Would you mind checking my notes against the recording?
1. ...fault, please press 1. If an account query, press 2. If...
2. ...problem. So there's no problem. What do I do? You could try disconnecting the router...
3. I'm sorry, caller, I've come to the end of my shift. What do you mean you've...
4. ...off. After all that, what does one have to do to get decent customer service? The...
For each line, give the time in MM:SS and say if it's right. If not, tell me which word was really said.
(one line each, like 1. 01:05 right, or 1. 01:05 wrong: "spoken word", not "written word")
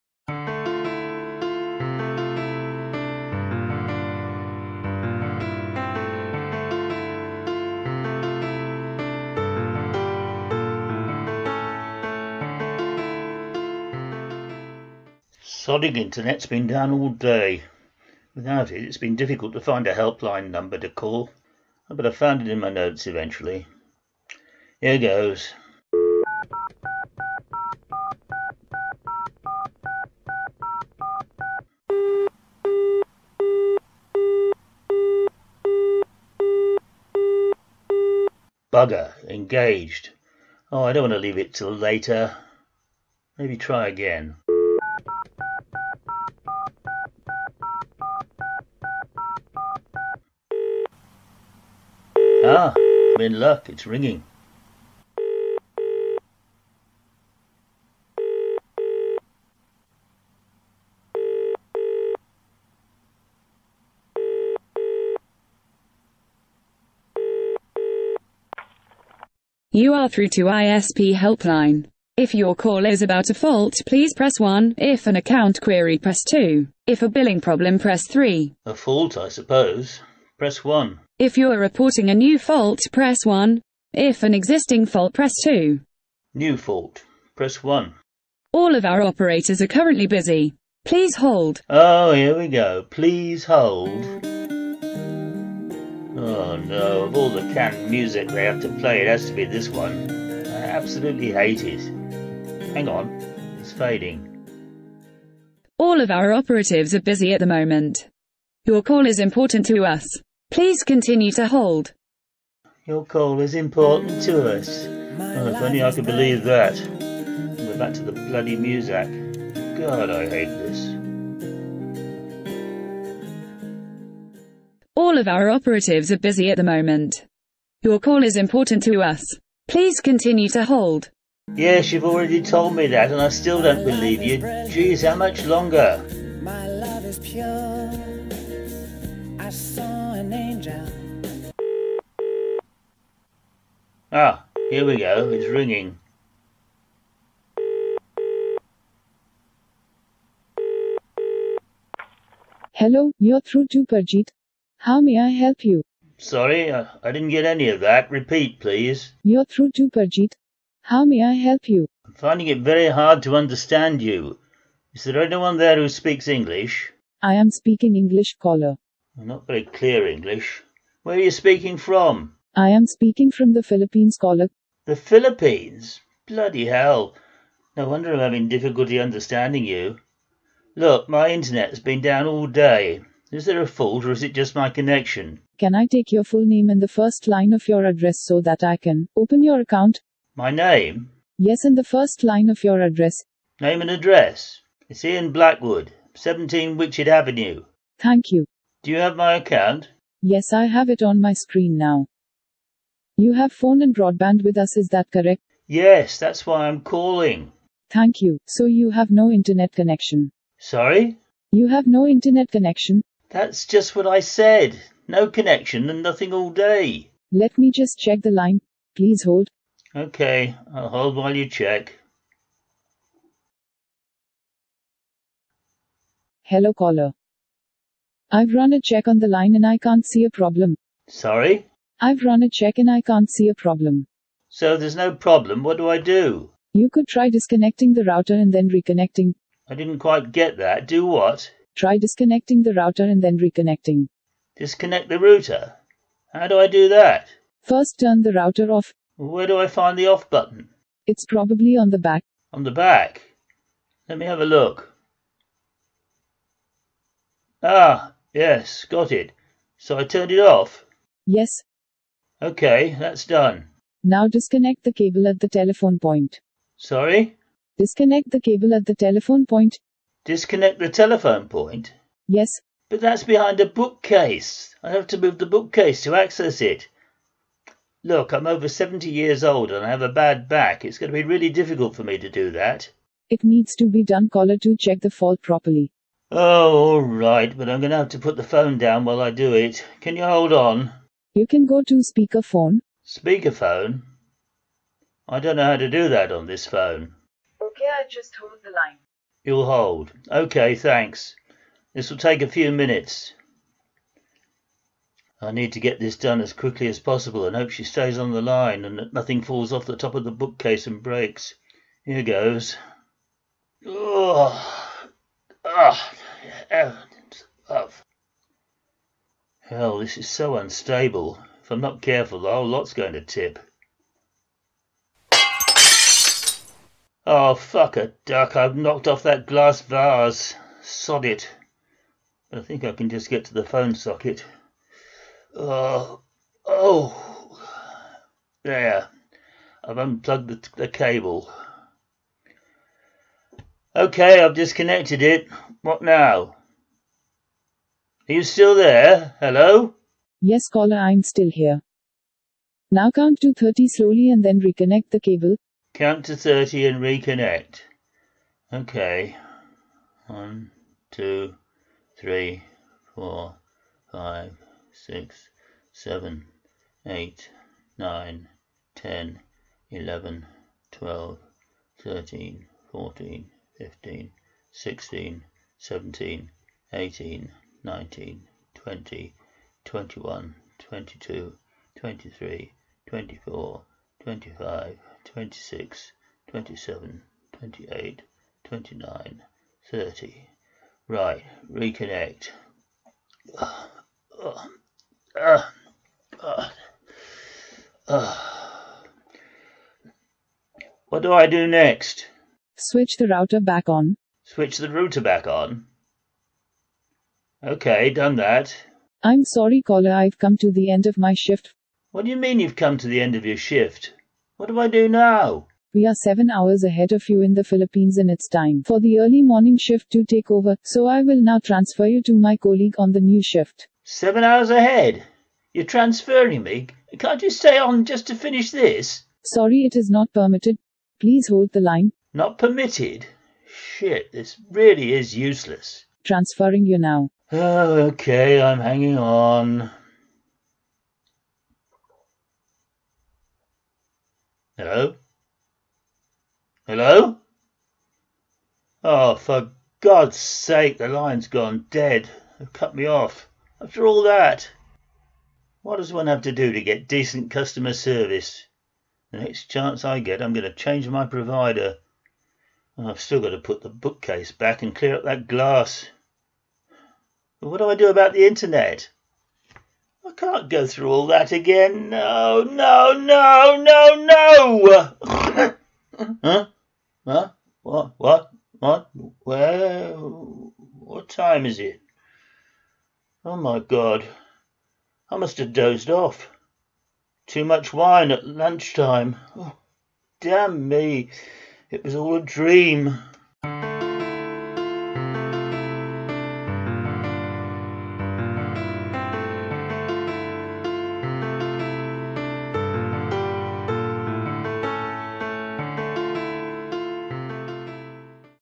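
1. 01:13 right
2. 03:53 right
3. 06:49 right
4. 07:33 right.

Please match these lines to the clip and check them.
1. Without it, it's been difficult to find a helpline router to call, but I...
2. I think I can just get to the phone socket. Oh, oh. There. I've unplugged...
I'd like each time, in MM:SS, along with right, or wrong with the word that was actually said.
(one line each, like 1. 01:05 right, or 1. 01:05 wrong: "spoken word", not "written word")
1. 00:18 wrong: "number", not "router"
2. 05:32 right.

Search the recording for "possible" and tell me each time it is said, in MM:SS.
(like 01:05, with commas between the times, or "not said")
05:07.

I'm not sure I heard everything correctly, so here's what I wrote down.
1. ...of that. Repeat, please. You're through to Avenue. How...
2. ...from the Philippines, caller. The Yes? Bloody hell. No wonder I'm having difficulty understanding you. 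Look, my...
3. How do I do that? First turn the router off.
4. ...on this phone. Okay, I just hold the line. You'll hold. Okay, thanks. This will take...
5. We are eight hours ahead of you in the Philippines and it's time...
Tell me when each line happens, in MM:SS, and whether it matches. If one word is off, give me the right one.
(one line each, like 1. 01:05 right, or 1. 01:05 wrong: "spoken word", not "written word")
1. 02:37 wrong: "Parjit", not "Avenue"
2. 02:53 wrong: "Philippines", not "Yes"
3. 04:06 right
4. 04:56 right
5. 06:55 wrong: "seven", not "eight".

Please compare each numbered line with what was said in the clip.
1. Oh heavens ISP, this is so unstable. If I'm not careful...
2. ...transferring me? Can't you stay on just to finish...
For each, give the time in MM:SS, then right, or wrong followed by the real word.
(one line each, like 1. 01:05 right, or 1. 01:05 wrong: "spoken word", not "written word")
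1. 05:15 wrong: "Hell", not "ISP"
2. 07:05 right.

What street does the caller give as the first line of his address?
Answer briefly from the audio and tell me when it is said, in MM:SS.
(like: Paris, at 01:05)
Witchet Avenue, at 03:16.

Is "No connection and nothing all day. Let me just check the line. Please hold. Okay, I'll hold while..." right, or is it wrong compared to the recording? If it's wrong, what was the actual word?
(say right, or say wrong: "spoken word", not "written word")
right.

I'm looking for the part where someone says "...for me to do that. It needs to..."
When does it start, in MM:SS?
04:41.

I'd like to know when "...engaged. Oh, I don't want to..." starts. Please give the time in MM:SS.
00:39.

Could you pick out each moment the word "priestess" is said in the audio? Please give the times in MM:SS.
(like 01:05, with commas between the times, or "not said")
not said.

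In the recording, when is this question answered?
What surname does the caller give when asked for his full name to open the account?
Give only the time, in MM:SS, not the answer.
03:15.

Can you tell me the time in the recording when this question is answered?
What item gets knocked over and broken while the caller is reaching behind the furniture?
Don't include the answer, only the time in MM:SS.
05:29.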